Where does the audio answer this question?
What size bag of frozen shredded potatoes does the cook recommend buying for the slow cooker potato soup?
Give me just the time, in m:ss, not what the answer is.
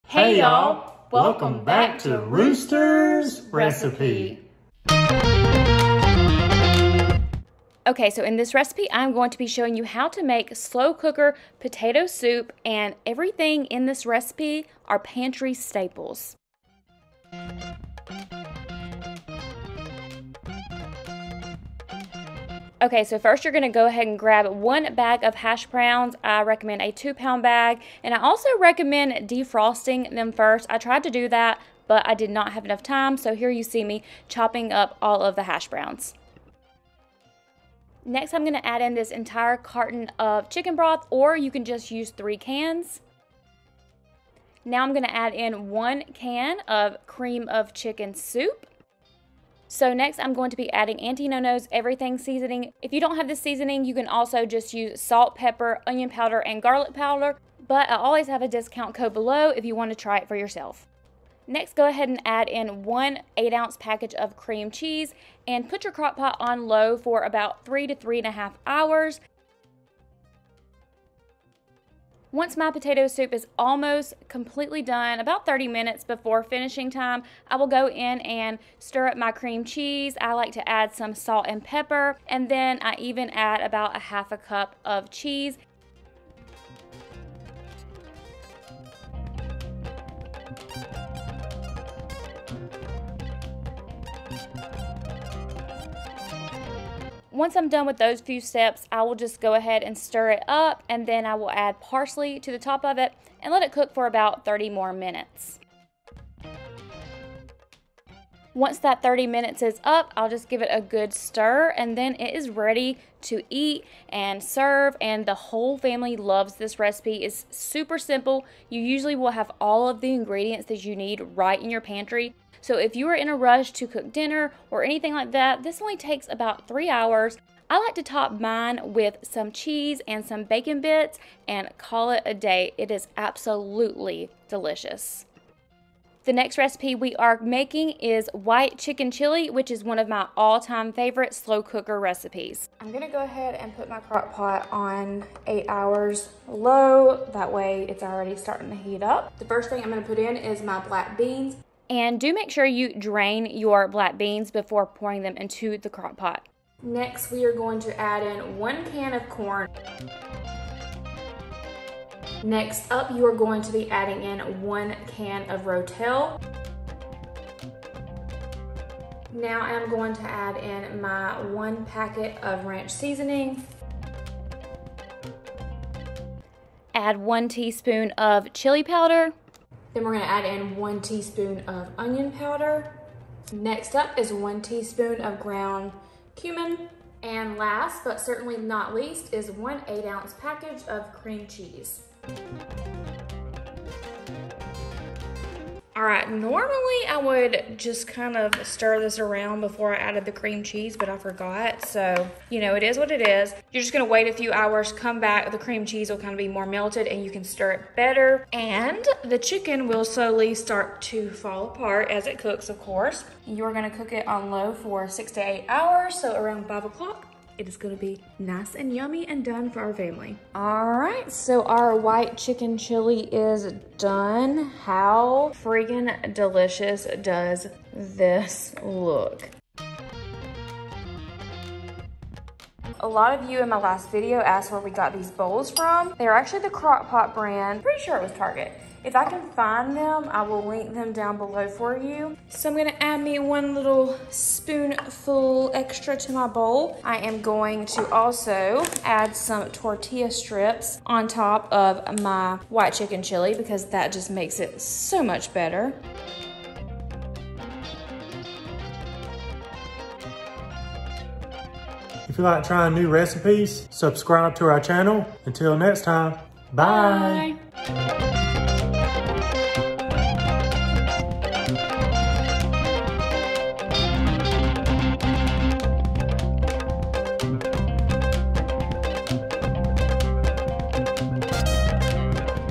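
0:26.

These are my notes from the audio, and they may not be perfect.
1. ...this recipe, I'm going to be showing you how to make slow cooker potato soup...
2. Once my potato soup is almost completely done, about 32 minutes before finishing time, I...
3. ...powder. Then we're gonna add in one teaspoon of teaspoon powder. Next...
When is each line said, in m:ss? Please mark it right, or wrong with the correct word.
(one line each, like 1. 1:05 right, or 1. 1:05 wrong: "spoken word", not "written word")
1. 0:08 right
2. 1:12 wrong: "30", not "32"
3. 2:58 wrong: "onion", not "teaspoon".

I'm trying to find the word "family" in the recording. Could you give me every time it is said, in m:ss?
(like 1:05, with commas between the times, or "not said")
1:55, 3:39.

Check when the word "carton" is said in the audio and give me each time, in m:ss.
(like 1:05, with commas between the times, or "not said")
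0:39.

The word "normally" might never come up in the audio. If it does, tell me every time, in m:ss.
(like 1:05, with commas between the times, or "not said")
3:16.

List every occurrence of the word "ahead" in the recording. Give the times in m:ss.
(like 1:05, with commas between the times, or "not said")
0:23, 1:01, 1:39, 2:23.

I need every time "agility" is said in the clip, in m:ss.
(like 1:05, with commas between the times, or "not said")
not said.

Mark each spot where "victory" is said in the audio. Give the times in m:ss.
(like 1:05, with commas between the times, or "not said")
not said.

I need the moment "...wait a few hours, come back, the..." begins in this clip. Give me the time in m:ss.
3:24.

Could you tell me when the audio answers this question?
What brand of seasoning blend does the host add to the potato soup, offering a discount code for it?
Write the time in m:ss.
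0:51.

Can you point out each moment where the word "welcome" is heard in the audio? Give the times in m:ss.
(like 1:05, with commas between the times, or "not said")
0:01.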